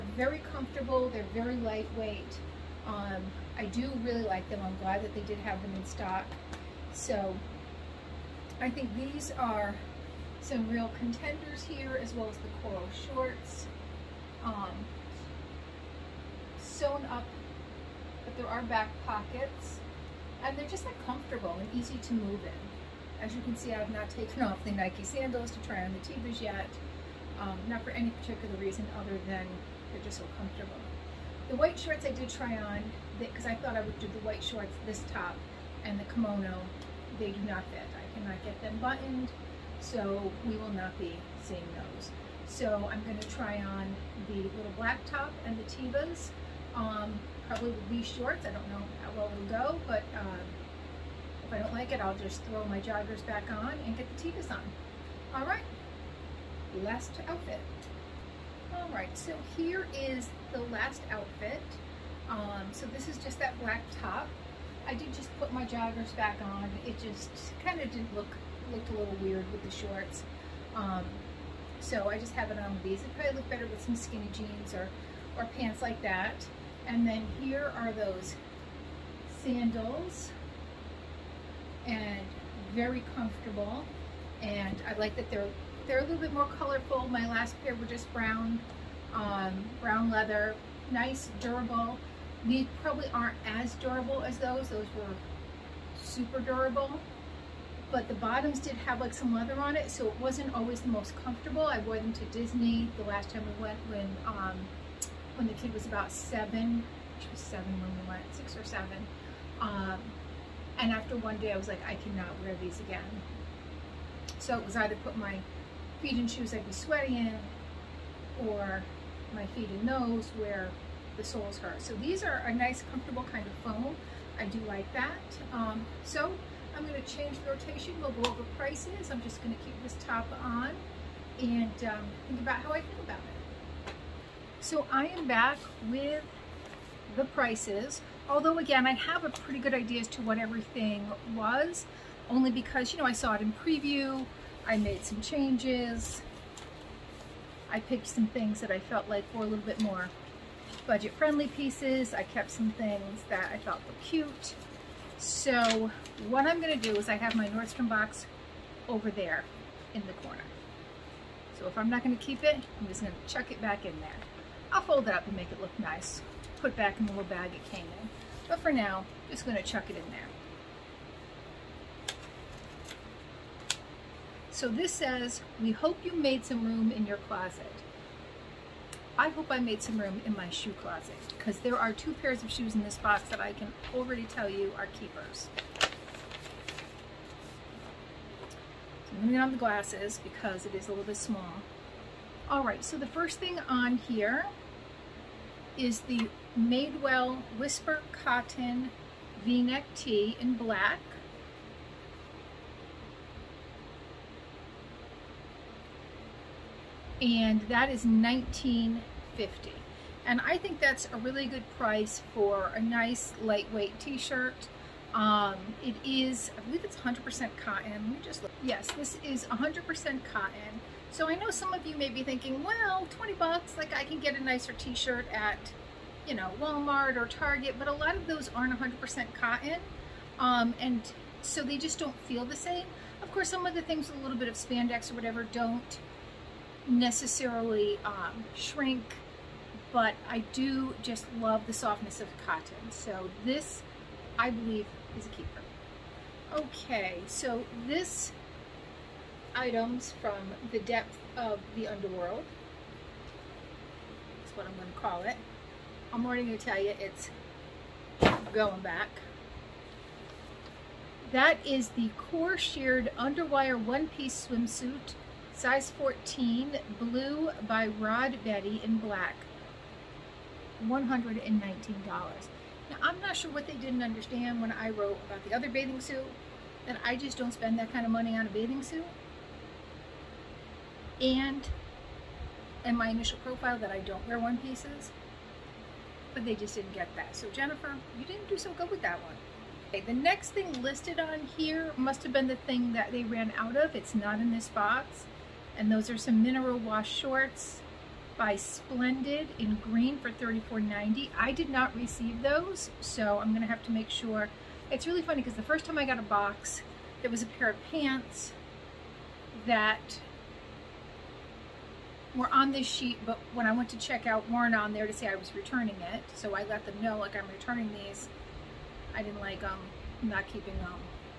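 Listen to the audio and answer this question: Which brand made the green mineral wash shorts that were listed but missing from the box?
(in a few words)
Splendid.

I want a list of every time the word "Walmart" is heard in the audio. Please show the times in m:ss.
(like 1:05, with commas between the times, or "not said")
3:46.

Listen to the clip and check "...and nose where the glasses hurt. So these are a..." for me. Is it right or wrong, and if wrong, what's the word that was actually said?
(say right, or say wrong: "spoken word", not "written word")
wrong: "soles", not "glasses".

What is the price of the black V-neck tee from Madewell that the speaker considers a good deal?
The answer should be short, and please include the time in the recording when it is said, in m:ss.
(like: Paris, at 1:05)
$19.50, at 3:28.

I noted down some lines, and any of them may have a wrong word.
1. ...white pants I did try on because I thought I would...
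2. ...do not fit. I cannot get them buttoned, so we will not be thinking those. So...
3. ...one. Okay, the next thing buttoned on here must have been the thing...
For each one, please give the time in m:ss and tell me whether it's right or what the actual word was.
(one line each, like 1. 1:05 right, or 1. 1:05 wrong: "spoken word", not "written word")
1. 0:31 wrong: "shorts", not "pants"
2. 0:37 wrong: "seeing", not "thinking"
3. 4:49 wrong: "listed", not "buttoned".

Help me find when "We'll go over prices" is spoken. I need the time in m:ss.
2:07.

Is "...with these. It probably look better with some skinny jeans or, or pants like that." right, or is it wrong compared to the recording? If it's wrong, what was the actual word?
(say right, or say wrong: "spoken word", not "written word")
right.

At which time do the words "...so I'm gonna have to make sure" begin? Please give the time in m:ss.
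5:02.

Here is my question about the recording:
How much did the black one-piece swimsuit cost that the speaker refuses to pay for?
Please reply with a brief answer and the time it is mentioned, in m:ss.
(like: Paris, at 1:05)
$119, at 4:30.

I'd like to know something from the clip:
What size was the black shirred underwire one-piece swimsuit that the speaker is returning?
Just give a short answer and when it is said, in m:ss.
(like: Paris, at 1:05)
14, at 4:25.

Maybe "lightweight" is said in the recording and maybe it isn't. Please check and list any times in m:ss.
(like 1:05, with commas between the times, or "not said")
0:01, 3:33.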